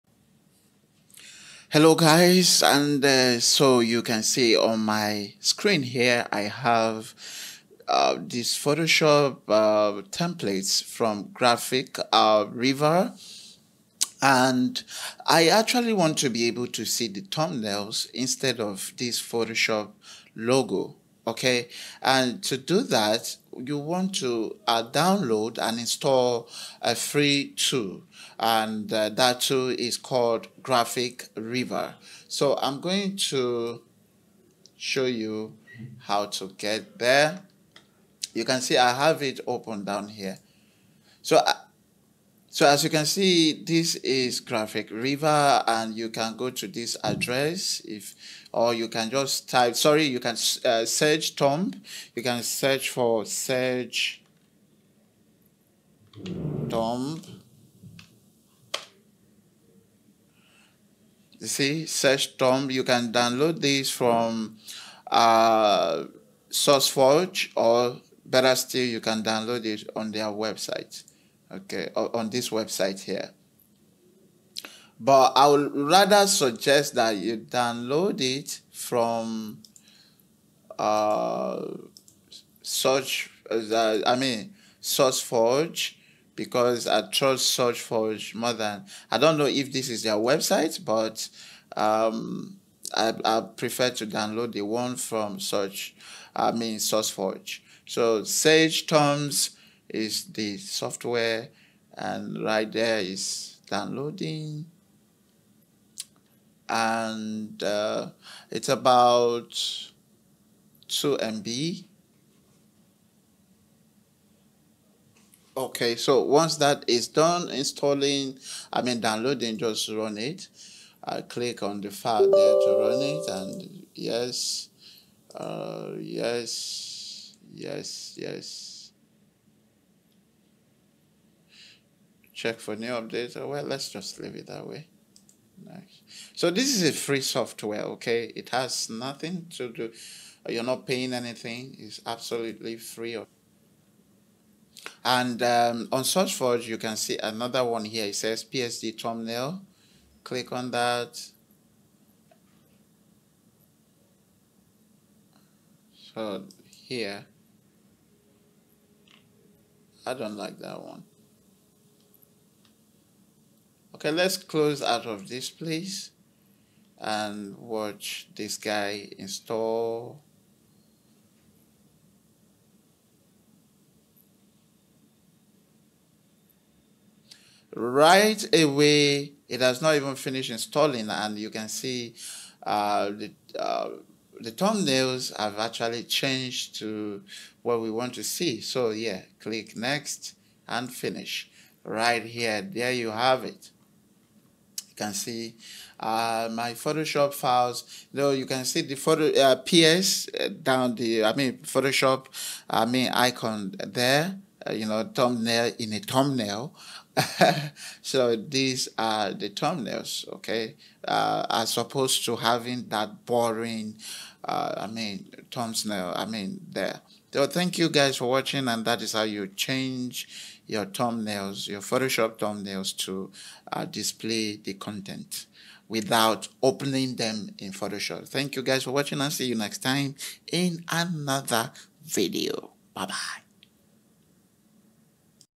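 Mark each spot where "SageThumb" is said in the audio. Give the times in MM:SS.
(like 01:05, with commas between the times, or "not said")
01:01, 01:38.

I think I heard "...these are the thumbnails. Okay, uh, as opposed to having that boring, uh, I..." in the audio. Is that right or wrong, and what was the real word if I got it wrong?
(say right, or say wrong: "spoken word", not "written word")
right.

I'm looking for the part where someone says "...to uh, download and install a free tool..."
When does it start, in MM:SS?
00:24.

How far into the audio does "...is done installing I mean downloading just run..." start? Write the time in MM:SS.
01:56.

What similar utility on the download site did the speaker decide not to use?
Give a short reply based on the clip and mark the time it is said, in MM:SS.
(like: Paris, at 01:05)
PSD thumbnail, at 02:28.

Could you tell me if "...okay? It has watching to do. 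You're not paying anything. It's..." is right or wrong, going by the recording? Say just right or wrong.
wrong.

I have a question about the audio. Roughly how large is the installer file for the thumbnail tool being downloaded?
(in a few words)
2 MB.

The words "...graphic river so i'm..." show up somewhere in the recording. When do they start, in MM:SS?
00:30.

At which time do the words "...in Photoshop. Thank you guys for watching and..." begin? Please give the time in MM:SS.
03:47.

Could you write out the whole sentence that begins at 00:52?
You can search for search Tomb.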